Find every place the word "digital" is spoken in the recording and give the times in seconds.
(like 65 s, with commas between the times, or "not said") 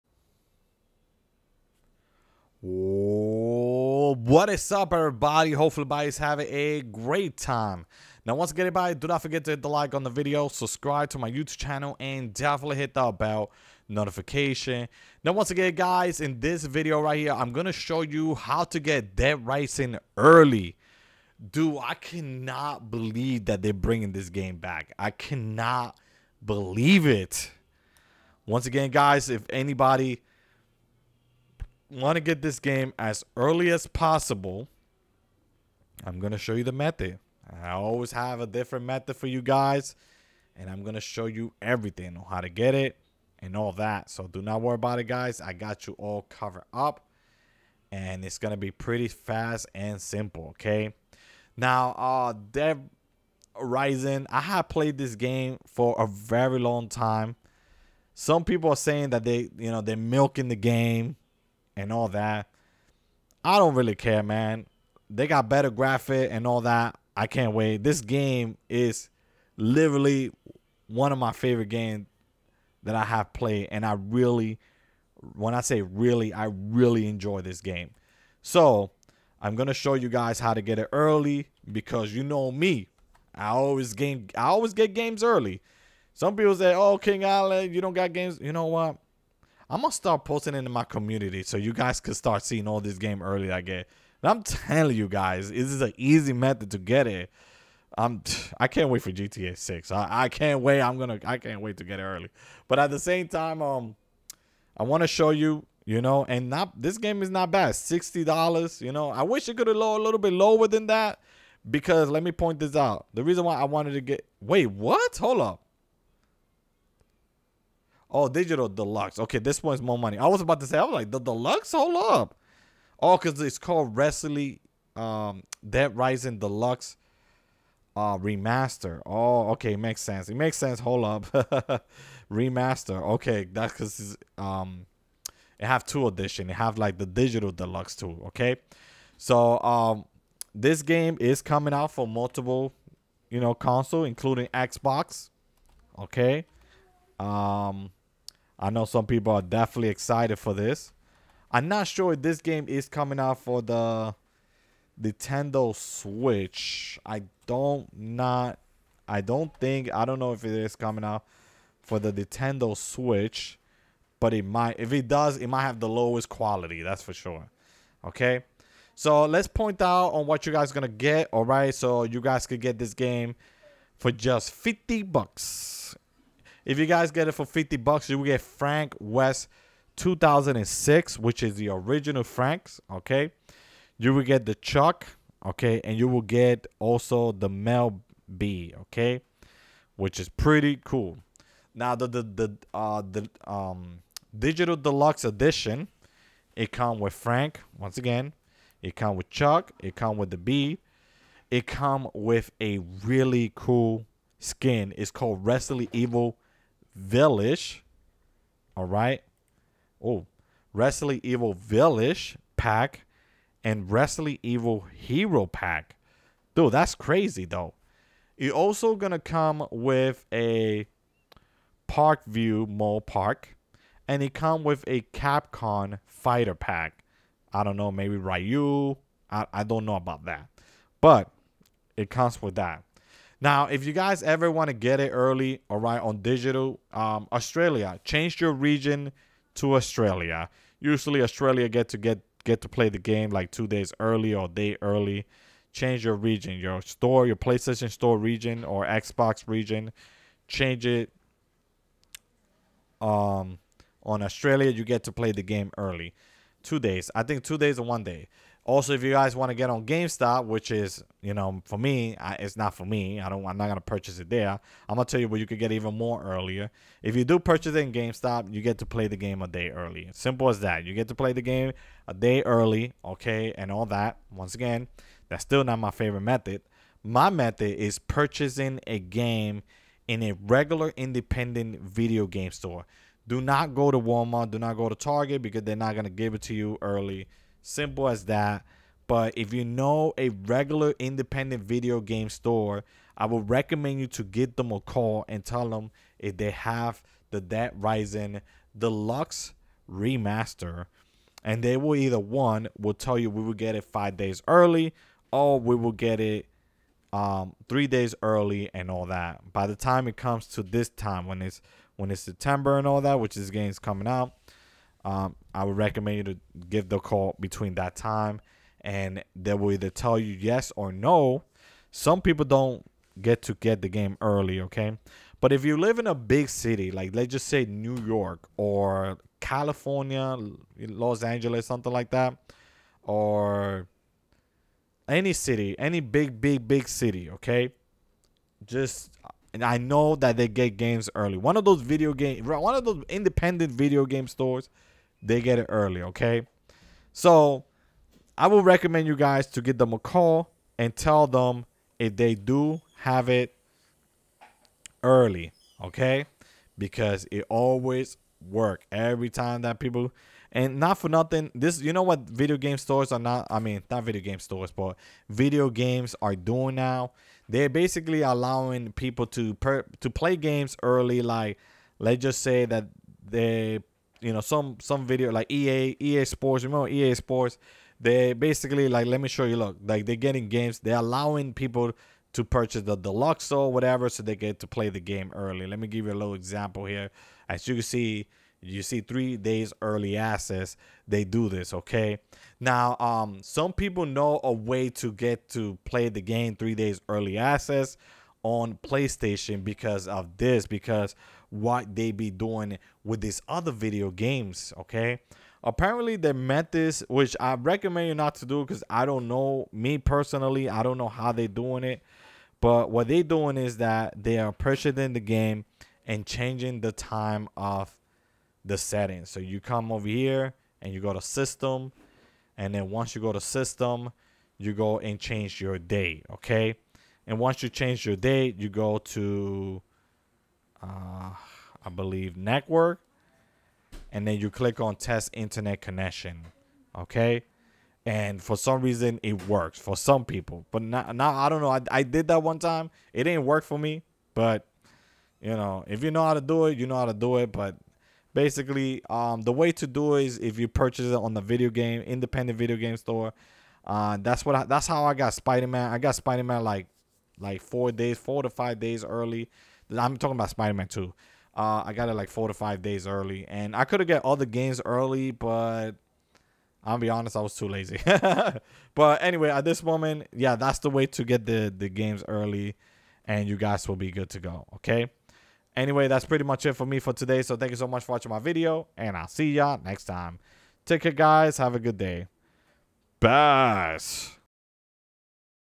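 118 s, 137 s, 194 s, 236 s.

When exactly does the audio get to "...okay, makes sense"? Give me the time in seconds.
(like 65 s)
129 s.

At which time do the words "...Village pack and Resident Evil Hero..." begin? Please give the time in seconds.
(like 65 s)
211 s.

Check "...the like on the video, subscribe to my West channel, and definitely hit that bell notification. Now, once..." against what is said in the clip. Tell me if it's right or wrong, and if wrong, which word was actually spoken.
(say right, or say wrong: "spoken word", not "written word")
wrong: "YouTube", not "West".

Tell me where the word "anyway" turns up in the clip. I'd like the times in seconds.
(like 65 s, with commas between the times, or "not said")
469 s, 475 s.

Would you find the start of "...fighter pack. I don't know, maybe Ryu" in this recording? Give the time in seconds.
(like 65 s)
226 s.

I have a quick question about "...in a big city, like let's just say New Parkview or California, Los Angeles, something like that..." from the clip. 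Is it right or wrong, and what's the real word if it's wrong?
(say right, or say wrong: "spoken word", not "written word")
wrong: "York", not "Parkview".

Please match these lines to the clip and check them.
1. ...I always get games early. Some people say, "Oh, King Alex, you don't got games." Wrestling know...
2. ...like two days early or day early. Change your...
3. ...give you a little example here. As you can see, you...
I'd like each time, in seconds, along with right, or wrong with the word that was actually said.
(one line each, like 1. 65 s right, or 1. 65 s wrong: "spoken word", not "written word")
1. 84 s wrong: "You", not "Wrestling"
2. 243 s right
3. 385 s right.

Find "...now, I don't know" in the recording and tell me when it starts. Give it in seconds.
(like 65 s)
440 s.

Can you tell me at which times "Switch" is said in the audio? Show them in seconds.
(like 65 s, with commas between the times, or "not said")
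155 s, 162 s.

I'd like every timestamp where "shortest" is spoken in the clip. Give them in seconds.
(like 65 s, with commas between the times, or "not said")
not said.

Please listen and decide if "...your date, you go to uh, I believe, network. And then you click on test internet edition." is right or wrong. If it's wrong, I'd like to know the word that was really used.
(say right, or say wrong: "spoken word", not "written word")
wrong: "connection", not "edition".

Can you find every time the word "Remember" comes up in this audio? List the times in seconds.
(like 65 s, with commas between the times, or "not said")
376 s.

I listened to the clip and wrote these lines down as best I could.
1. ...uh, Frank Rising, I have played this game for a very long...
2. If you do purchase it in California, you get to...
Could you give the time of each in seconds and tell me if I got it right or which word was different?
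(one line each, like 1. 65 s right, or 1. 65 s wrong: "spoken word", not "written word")
1. 51 s wrong: "Dead", not "Frank"
2. 267 s wrong: "GameStop", not "California".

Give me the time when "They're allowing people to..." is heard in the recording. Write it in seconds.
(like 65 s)
380 s.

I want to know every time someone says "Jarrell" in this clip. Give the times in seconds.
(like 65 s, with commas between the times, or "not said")
not said.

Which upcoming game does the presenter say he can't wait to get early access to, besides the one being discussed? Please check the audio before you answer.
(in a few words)
GTA 6.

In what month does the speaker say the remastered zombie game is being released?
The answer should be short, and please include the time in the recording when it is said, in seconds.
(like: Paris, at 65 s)
September, at 312 s.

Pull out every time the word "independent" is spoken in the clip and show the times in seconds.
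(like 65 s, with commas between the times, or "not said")
280 s, 290 s, 343 s, 452 s.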